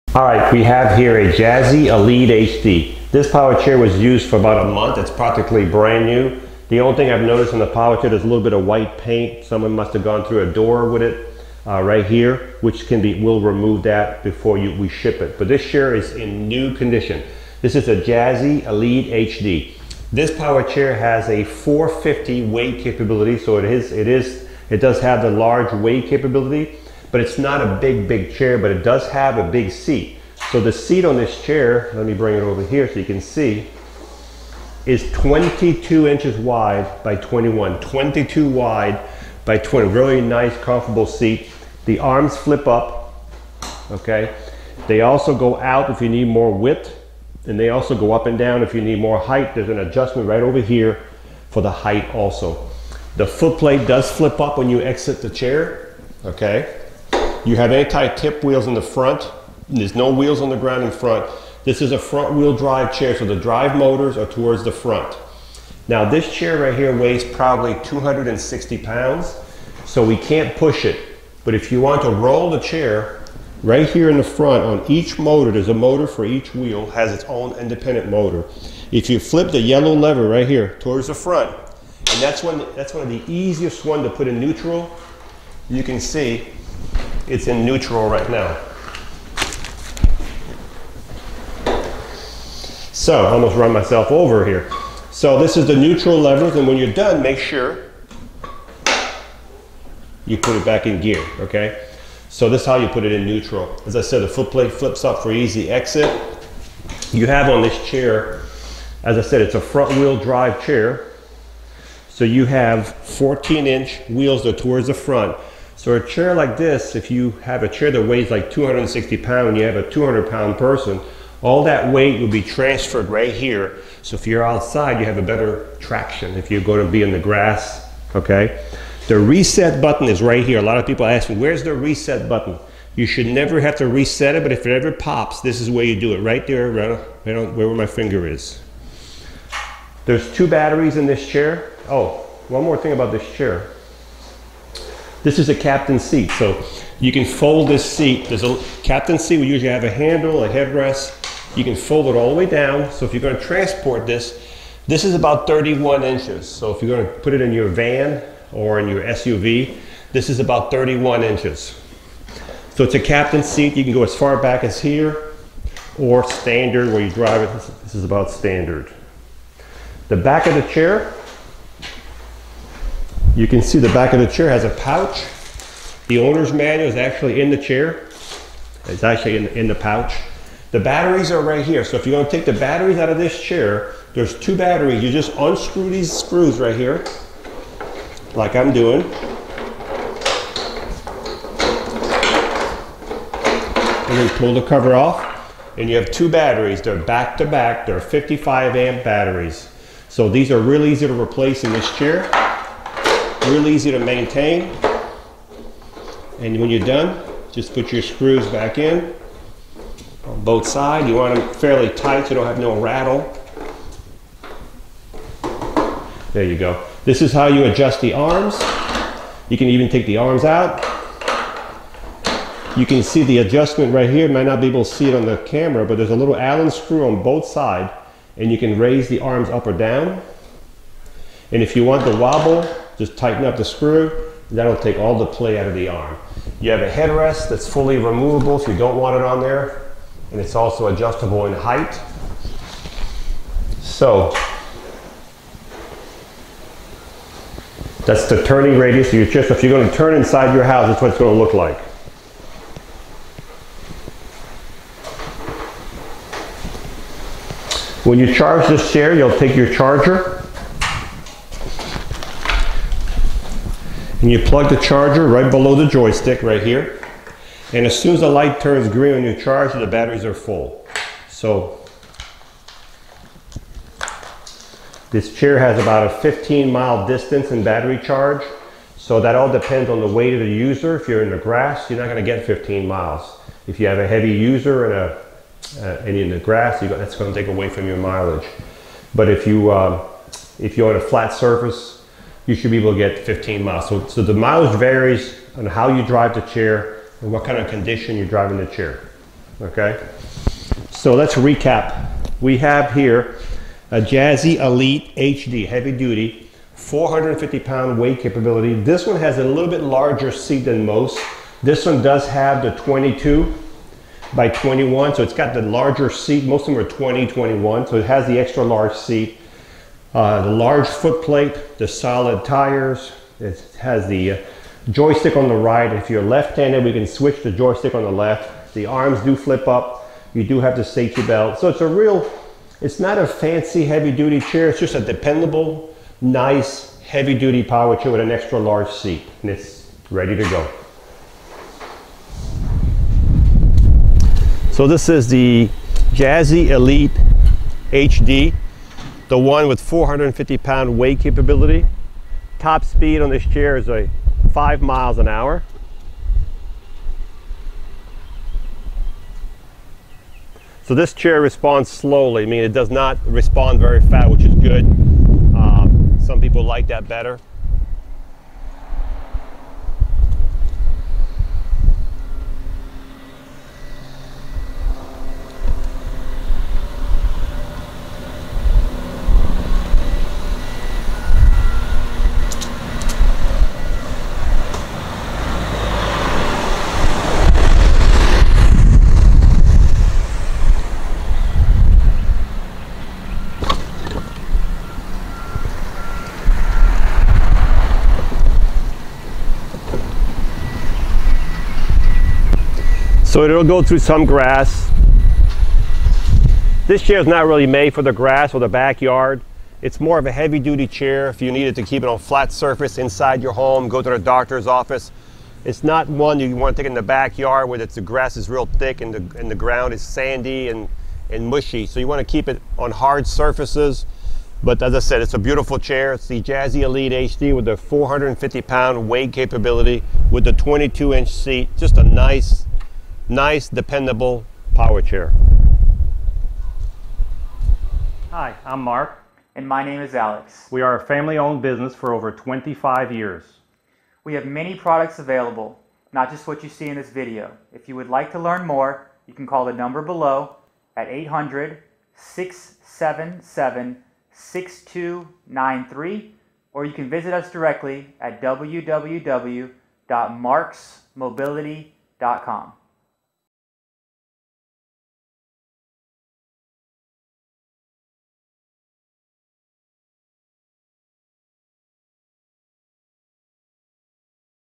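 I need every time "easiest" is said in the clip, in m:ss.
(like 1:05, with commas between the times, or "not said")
1:23.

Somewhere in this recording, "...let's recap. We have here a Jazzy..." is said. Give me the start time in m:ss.
5:01.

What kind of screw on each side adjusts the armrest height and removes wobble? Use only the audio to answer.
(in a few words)
Allen screw.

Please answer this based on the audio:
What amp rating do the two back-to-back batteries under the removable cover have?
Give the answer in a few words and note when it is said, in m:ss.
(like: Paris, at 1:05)
55 amp, at 3:18.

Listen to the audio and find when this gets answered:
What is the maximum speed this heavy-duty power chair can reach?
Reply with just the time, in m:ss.
5:54.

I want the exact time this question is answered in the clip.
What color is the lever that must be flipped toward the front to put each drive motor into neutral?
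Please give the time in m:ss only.
1:19.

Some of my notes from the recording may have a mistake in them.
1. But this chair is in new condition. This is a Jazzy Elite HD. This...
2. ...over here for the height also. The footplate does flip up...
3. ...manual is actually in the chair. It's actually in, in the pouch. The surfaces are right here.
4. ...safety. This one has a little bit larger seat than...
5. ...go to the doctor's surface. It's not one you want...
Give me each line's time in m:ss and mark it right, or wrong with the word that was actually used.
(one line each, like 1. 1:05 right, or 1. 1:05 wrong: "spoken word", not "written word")
1. 0:15 right
2. 0:50 right
3. 2:56 wrong: "batteries", not "surfaces"
4. 5:08 wrong: "capability", not "safety"
5. 6:53 wrong: "office", not "surface".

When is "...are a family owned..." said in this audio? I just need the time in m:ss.
7:20.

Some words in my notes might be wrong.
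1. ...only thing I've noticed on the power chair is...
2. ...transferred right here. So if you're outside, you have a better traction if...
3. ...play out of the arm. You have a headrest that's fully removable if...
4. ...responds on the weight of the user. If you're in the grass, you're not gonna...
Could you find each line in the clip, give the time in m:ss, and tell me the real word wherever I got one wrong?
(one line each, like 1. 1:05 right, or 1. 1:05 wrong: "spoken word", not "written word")
1. 0:06 right
2. 2:02 right
3. 3:55 right
4. 4:39 wrong: "depends", not "responds".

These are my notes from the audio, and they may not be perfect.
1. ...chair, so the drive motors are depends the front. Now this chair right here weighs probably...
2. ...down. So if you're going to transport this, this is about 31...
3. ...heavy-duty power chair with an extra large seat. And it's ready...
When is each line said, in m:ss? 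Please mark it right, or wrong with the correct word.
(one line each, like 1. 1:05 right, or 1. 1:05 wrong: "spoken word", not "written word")
1. 1:02 wrong: "towards", not "depends"
2. 2:32 right
3. 5:36 right.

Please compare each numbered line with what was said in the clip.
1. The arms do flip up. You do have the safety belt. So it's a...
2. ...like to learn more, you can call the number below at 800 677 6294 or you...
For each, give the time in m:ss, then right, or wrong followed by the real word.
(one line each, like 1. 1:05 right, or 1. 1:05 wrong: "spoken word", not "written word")
1. 5:28 right
2. 7:28 wrong: "6293", not "6294".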